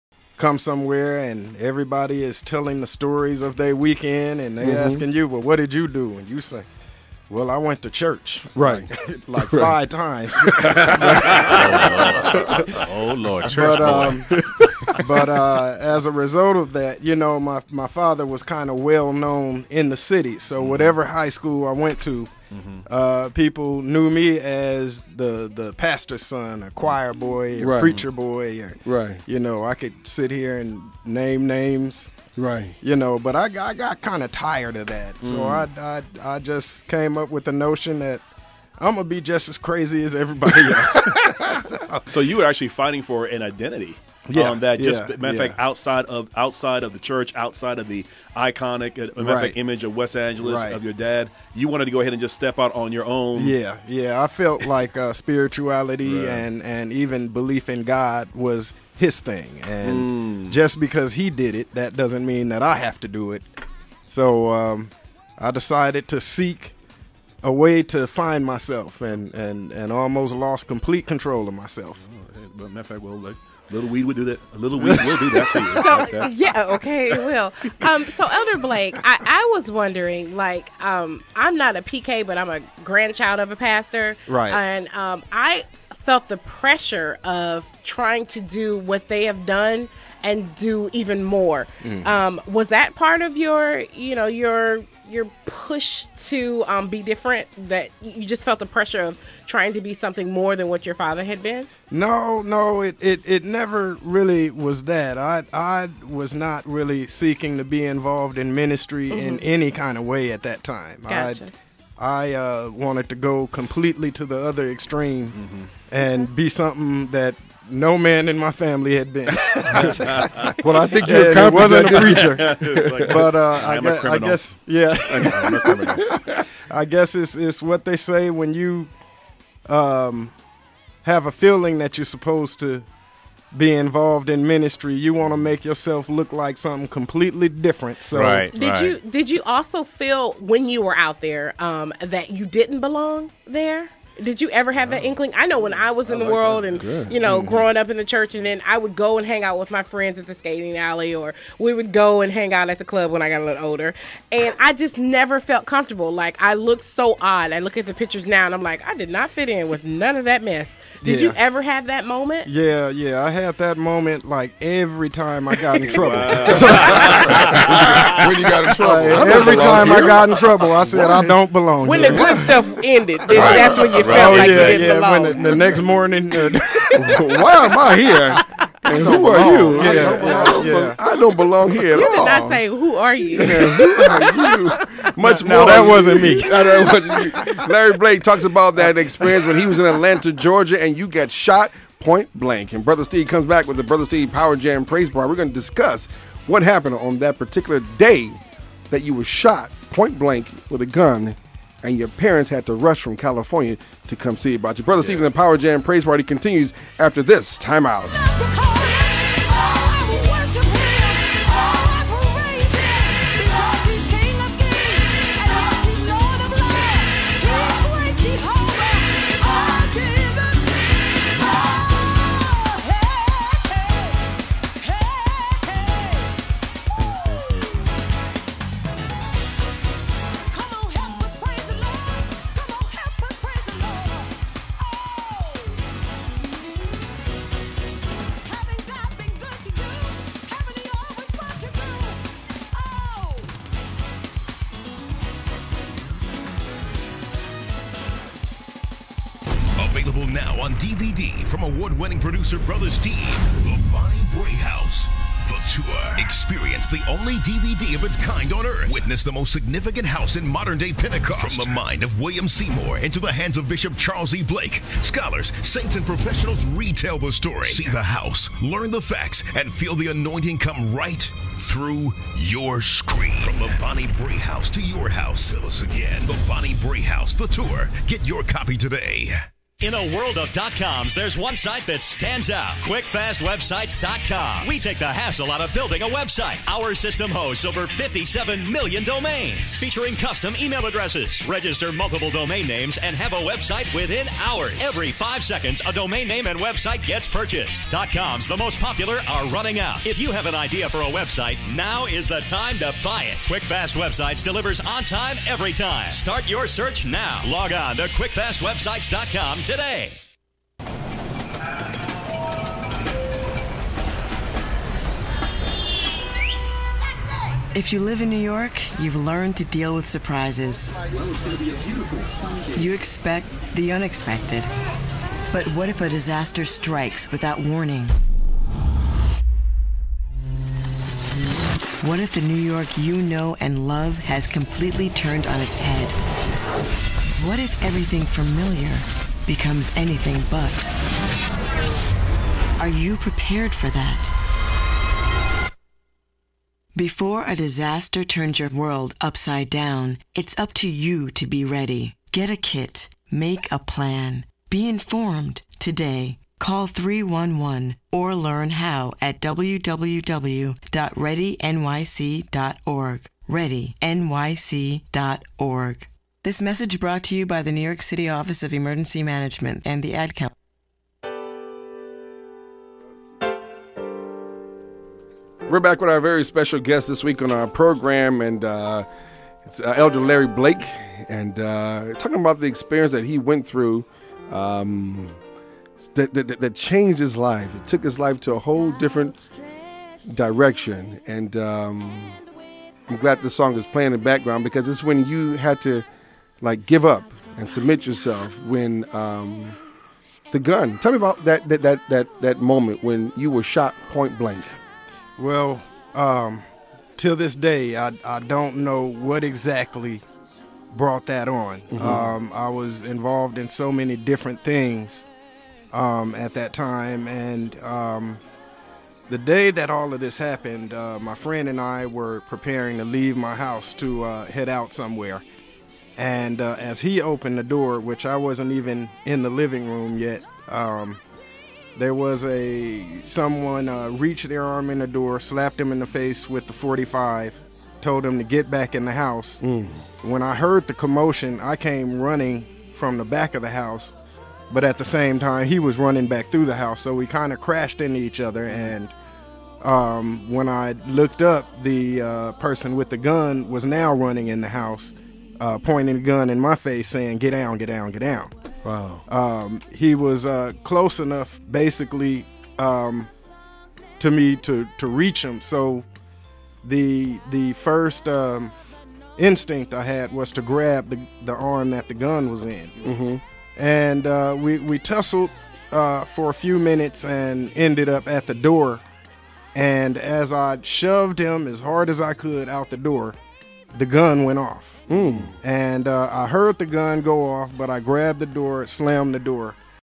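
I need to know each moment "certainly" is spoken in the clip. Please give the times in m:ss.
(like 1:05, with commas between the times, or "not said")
not said.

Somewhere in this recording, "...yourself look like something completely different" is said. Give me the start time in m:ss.
2:15.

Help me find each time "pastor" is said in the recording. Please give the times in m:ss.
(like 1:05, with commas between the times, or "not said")
0:25, 1:23.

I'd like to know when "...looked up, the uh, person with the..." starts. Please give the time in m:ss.
7:31.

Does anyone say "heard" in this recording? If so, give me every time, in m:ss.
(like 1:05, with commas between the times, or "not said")
7:20, 8:06.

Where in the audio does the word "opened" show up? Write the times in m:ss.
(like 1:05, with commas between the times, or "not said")
7:07.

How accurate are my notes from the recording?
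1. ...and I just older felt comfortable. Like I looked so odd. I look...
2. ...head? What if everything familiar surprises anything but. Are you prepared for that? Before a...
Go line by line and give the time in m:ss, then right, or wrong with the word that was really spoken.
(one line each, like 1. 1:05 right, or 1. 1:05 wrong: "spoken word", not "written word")
1. 2:34 wrong: "never", not "older"
2. 5:35 wrong: "becomes", not "surprises".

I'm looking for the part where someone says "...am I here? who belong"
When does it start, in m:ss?
2:57.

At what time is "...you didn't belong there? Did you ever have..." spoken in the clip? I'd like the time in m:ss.
2:22.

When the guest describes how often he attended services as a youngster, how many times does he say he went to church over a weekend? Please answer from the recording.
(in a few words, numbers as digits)
5.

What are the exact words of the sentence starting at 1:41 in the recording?
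No, no, it it, it never really was that.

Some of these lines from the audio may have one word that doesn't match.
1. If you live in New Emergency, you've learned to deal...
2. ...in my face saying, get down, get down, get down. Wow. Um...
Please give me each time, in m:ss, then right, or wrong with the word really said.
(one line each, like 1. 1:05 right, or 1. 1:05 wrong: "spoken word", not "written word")
1. 5:17 wrong: "York", not "Emergency"
2. 7:36 right.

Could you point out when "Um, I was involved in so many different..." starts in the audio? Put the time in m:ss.
6:52.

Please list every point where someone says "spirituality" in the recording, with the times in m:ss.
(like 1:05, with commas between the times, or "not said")
0:55.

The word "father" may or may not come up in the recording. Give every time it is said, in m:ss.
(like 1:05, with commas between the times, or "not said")
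0:17, 1:40.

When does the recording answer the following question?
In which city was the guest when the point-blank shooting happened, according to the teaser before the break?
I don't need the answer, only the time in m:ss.
3:09.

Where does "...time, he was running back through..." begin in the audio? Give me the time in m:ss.
7:25.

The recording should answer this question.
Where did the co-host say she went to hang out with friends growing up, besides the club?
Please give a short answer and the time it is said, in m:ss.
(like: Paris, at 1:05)
Skating alley, at 2:30.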